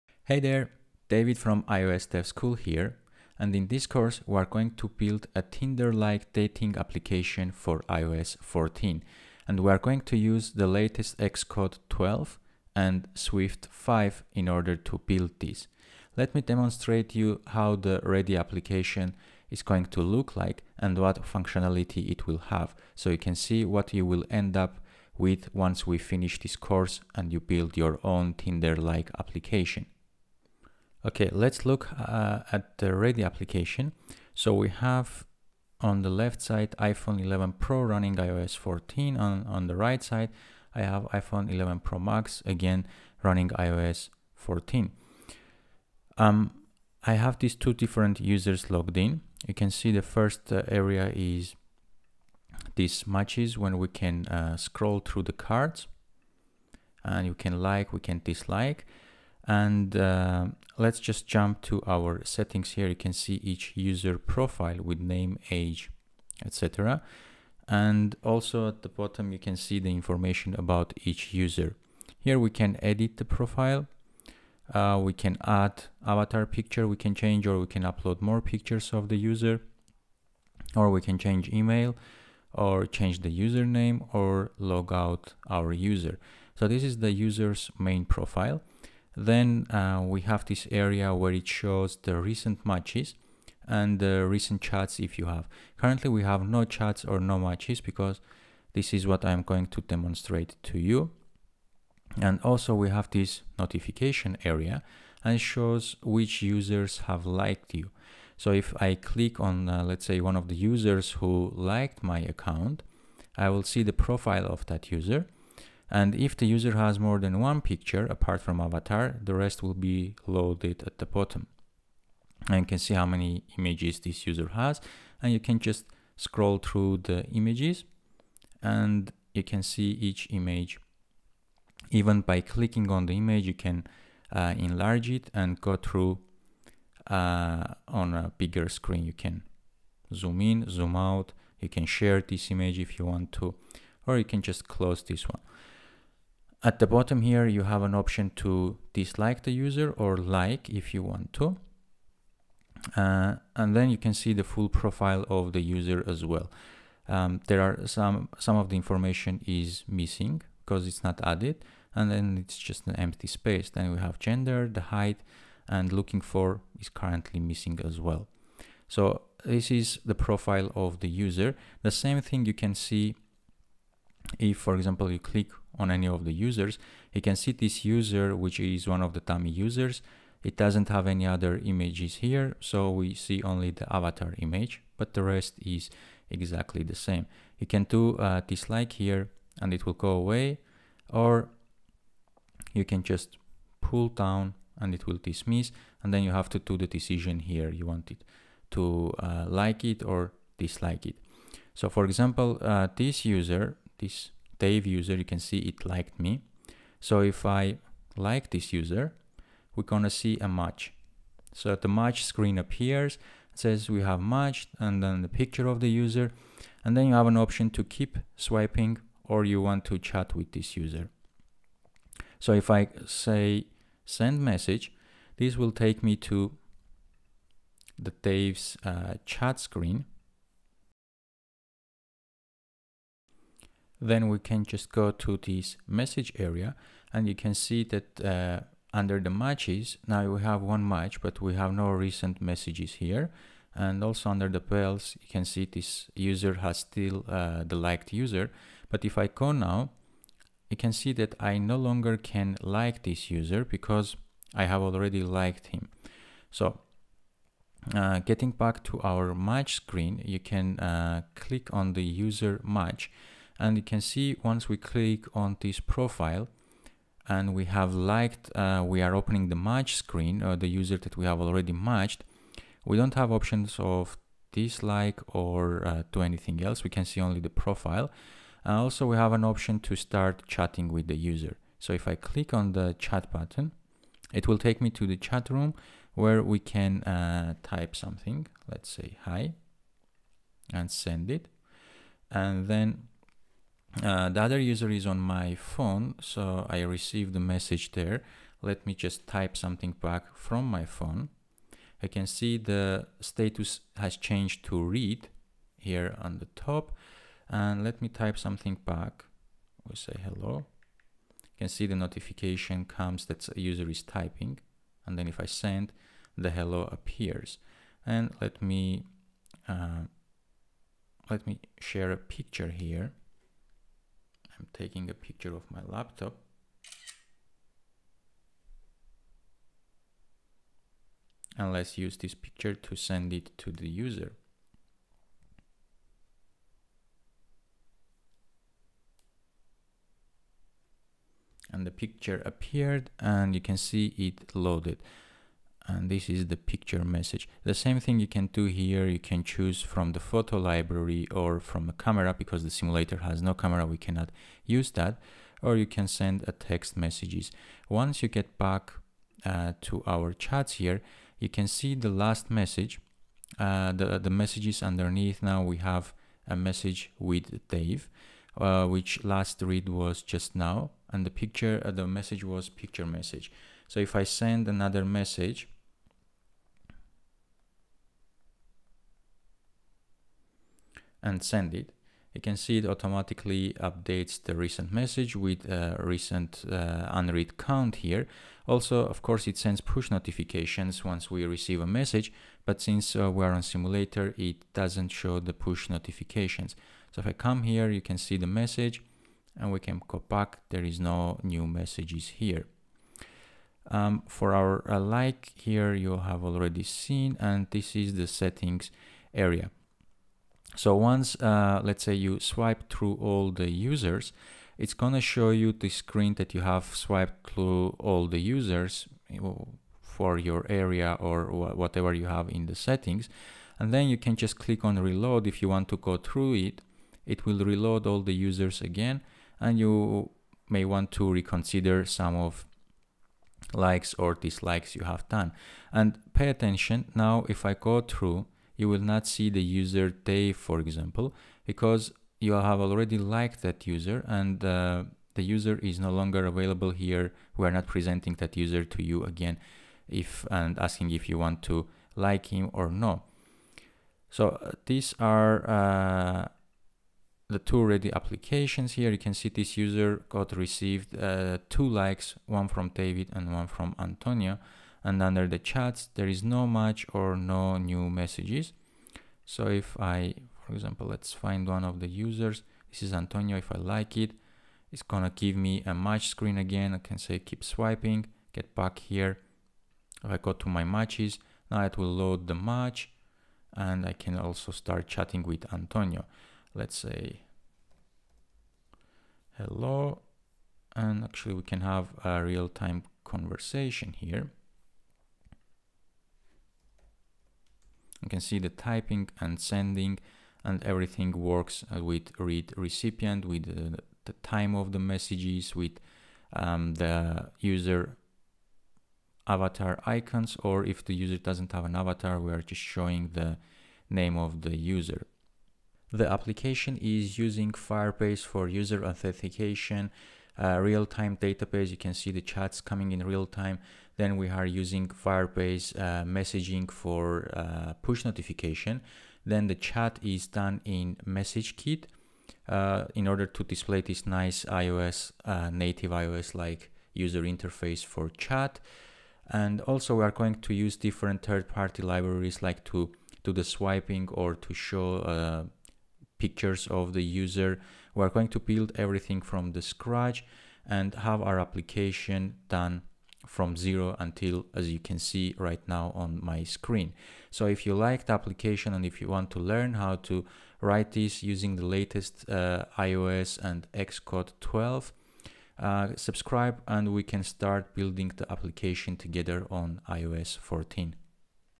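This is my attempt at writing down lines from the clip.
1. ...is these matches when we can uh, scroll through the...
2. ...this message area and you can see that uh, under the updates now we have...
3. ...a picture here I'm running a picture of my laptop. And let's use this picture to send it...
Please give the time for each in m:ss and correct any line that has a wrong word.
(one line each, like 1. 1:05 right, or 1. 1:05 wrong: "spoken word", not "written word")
1. 0:51 right
2. 3:55 wrong: "matches", not "updates"
3. 5:22 wrong: "taking", not "running".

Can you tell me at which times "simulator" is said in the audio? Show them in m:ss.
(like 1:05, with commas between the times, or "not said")
5:52, 6:33.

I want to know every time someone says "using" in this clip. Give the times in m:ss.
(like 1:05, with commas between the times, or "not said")
8:37, 8:44, 9:21.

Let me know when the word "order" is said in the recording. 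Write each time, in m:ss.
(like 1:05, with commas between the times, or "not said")
0:14, 8:53.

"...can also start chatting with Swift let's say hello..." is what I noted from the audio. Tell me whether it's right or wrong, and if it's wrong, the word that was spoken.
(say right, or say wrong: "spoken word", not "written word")
wrong: "Antonio", not "Swift".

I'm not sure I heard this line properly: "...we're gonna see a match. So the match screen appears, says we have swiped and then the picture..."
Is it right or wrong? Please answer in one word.
wrong.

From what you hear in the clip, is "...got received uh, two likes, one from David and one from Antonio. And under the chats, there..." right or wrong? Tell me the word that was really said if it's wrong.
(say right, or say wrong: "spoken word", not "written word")
right.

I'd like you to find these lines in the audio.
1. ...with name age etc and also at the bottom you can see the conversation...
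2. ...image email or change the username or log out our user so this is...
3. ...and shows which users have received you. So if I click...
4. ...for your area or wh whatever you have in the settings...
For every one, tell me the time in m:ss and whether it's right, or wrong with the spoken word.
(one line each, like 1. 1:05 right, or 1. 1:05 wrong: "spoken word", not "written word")
1. 1:04 wrong: "information", not "conversation"
2. 1:21 wrong: "change", not "image"
3. 1:45 wrong: "liked", not "received"
4. 6:59 right.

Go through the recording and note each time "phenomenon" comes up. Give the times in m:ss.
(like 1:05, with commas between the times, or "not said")
not said.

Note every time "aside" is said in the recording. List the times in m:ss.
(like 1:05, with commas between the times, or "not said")
not said.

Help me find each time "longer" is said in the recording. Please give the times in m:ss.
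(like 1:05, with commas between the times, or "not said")
4:11, 7:26.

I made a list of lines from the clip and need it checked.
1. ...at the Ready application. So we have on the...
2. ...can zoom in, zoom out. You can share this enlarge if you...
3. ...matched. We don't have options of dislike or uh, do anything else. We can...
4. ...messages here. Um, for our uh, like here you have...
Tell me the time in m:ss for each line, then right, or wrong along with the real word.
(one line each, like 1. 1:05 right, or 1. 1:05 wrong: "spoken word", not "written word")
1. 0:32 right
2. 2:19 wrong: "image", not "enlarge"
3. 4:31 right
4. 6:41 right.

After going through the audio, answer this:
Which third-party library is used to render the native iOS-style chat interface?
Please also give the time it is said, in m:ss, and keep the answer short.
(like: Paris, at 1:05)
MessageKit, at 8:51.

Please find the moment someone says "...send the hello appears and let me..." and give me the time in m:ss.
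5:15.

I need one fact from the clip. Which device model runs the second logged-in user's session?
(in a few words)
iPhone 11 Pro Max.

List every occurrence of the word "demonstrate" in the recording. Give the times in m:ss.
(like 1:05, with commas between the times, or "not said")
0:16, 1:39.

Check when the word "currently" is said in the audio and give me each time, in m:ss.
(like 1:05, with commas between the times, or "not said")
1:35, 2:46.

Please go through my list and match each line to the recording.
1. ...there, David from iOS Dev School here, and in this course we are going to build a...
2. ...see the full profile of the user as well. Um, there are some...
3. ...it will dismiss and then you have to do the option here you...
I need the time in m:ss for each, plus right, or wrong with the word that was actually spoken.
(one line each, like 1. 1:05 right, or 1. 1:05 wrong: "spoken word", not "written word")
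1. 0:00 right
2. 2:34 right
3. 3:14 wrong: "decision", not "option".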